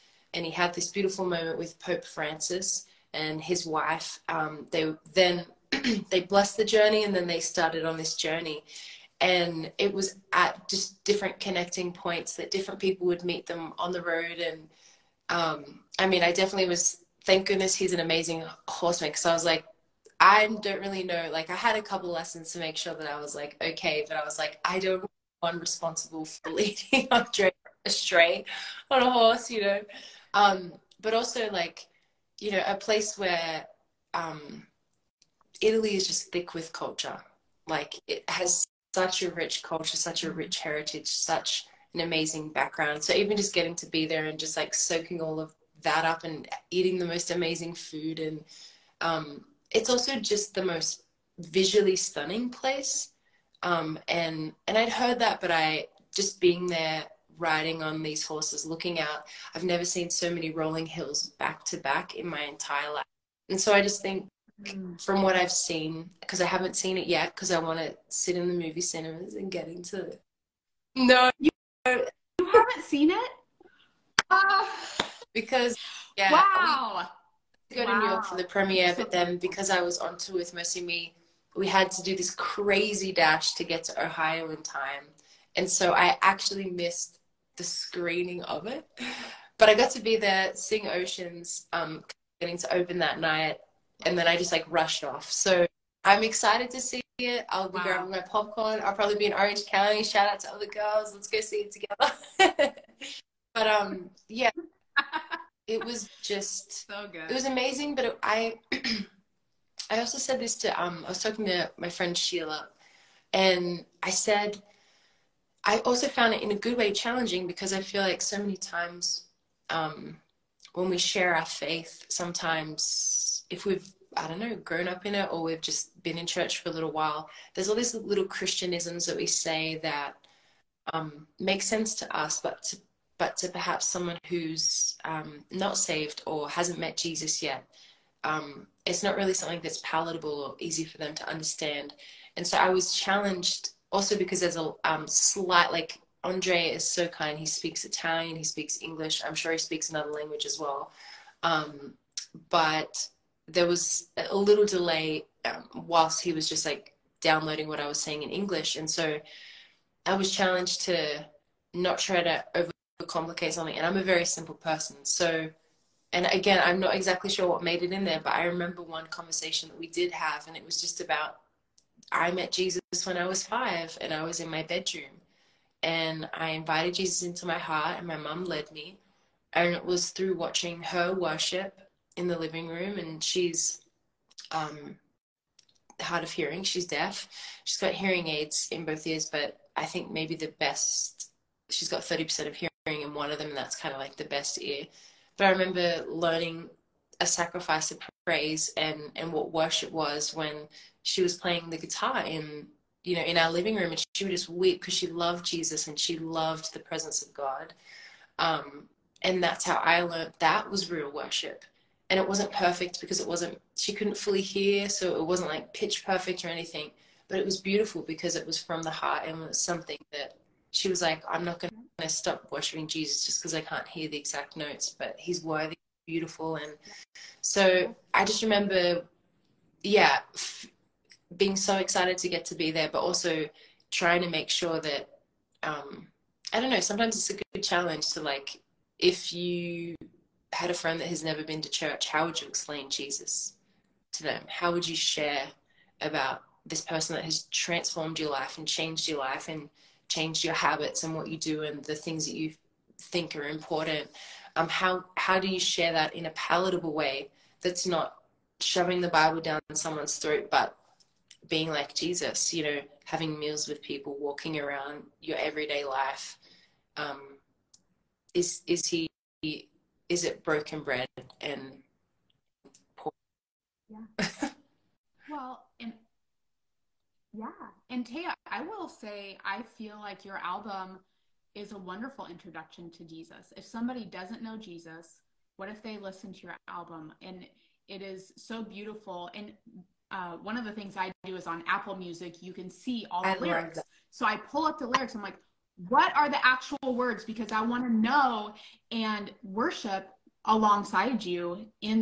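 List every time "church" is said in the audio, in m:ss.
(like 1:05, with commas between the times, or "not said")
2:06, 4:01.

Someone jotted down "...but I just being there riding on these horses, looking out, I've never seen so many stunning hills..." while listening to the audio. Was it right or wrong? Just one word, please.
wrong.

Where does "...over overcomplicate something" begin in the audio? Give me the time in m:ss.
2:42.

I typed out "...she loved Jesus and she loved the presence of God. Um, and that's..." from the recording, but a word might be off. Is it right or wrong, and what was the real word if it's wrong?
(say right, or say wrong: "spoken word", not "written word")
right.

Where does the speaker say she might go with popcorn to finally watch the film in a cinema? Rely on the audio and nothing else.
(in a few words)
Orange County.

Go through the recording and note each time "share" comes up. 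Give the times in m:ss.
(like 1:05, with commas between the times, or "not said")
2:00, 4:04, 4:15.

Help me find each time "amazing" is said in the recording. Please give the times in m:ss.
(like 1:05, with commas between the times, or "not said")
0:18, 0:42, 0:47, 1:47.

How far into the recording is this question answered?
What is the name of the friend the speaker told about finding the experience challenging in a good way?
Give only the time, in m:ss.
1:52.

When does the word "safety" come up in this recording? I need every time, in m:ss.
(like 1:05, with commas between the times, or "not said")
not said.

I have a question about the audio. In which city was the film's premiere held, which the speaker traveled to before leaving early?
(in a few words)
New York.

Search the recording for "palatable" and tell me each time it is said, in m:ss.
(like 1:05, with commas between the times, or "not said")
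2:19, 4:16.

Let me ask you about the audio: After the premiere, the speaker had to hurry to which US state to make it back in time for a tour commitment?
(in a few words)
Ohio.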